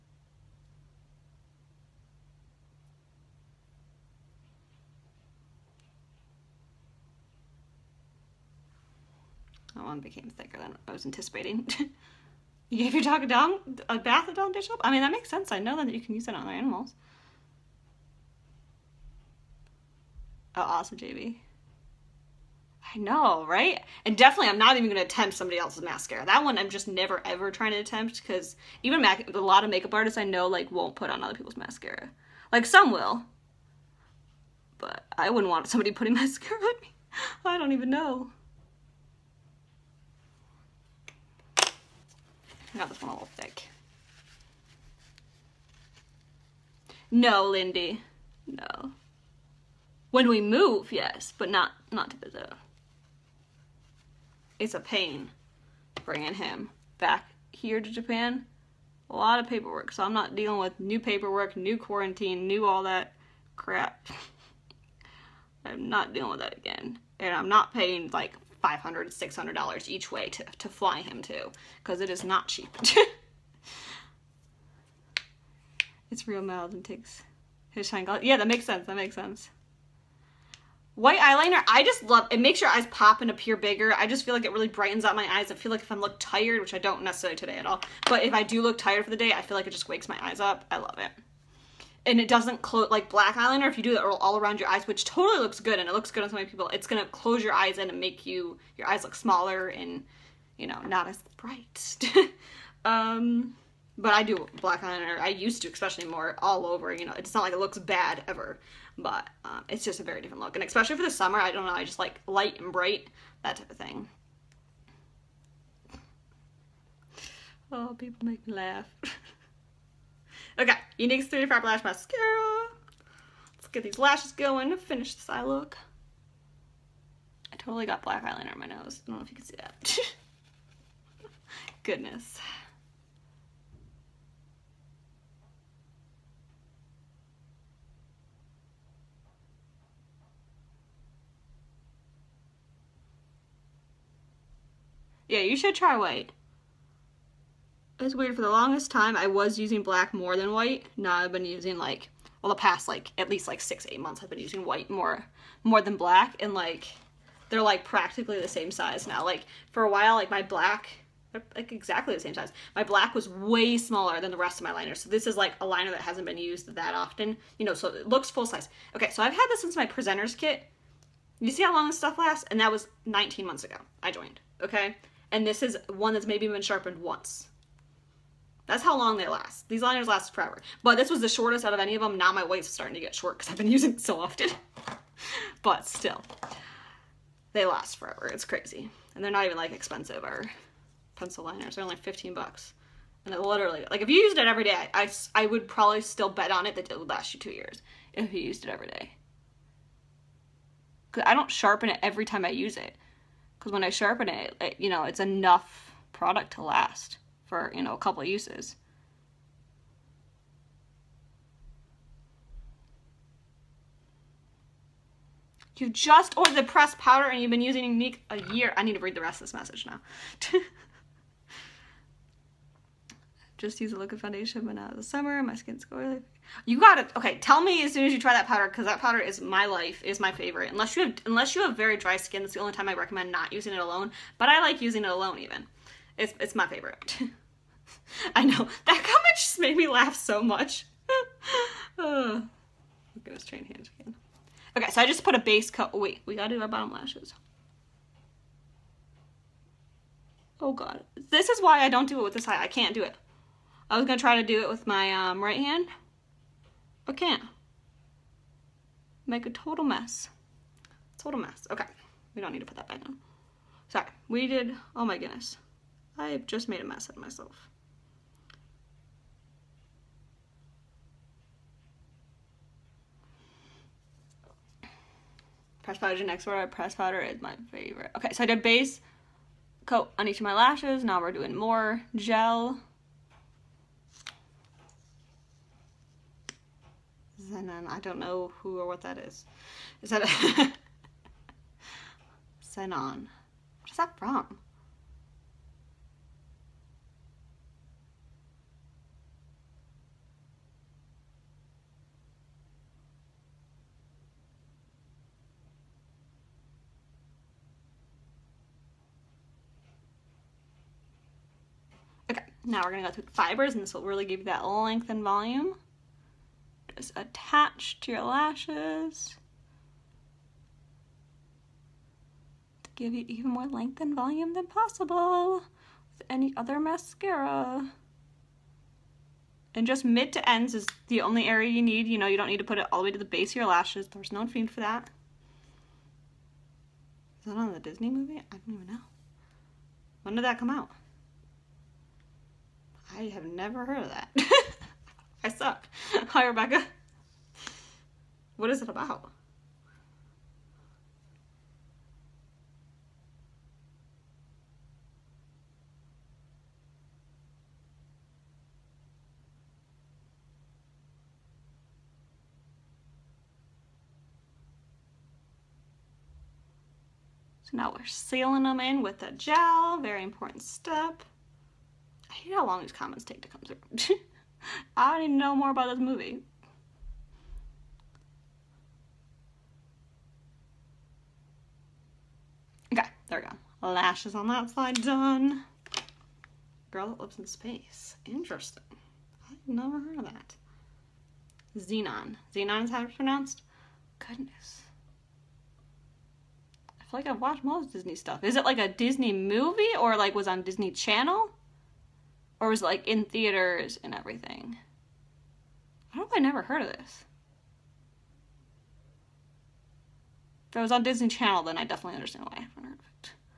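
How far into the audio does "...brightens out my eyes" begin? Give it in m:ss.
1:24.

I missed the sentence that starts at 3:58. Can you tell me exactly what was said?
That comment just made me laugh so much.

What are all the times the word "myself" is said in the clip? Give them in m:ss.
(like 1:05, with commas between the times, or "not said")
4:27.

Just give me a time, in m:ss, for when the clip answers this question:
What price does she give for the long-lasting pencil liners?
3:11.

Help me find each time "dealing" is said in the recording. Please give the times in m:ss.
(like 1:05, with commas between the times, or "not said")
1:00, 1:06.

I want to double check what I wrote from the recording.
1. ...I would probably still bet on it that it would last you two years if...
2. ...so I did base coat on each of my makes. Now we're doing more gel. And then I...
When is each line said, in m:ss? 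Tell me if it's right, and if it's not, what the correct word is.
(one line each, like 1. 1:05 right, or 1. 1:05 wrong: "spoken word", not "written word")
1. 3:15 right
2. 4:38 wrong: "lashes", not "makes".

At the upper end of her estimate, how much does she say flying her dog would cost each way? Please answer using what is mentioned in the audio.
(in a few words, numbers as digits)
$600.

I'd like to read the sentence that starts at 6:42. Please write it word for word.
or was like in theaters and everything.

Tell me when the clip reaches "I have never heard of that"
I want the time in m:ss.
5:43.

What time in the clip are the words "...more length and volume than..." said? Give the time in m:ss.
5:23.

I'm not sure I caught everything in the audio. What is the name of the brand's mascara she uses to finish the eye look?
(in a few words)
Younique's 35 Lash Mascara.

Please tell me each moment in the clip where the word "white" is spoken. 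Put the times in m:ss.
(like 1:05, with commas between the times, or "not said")
1:20, 2:25, 2:30, 2:34.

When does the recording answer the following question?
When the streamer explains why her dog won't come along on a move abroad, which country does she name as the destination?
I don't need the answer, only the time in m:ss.
0:52.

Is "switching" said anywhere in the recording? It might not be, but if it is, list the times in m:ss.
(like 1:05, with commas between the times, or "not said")
not said.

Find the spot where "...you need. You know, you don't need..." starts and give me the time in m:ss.
5:31.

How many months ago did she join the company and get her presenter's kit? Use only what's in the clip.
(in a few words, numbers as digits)
19 months.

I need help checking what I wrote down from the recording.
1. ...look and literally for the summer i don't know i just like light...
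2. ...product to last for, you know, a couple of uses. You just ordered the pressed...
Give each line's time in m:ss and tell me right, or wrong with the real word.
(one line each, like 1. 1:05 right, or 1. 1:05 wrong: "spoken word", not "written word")
1. 1:50 wrong: "especially", not "literally"
2. 3:26 right.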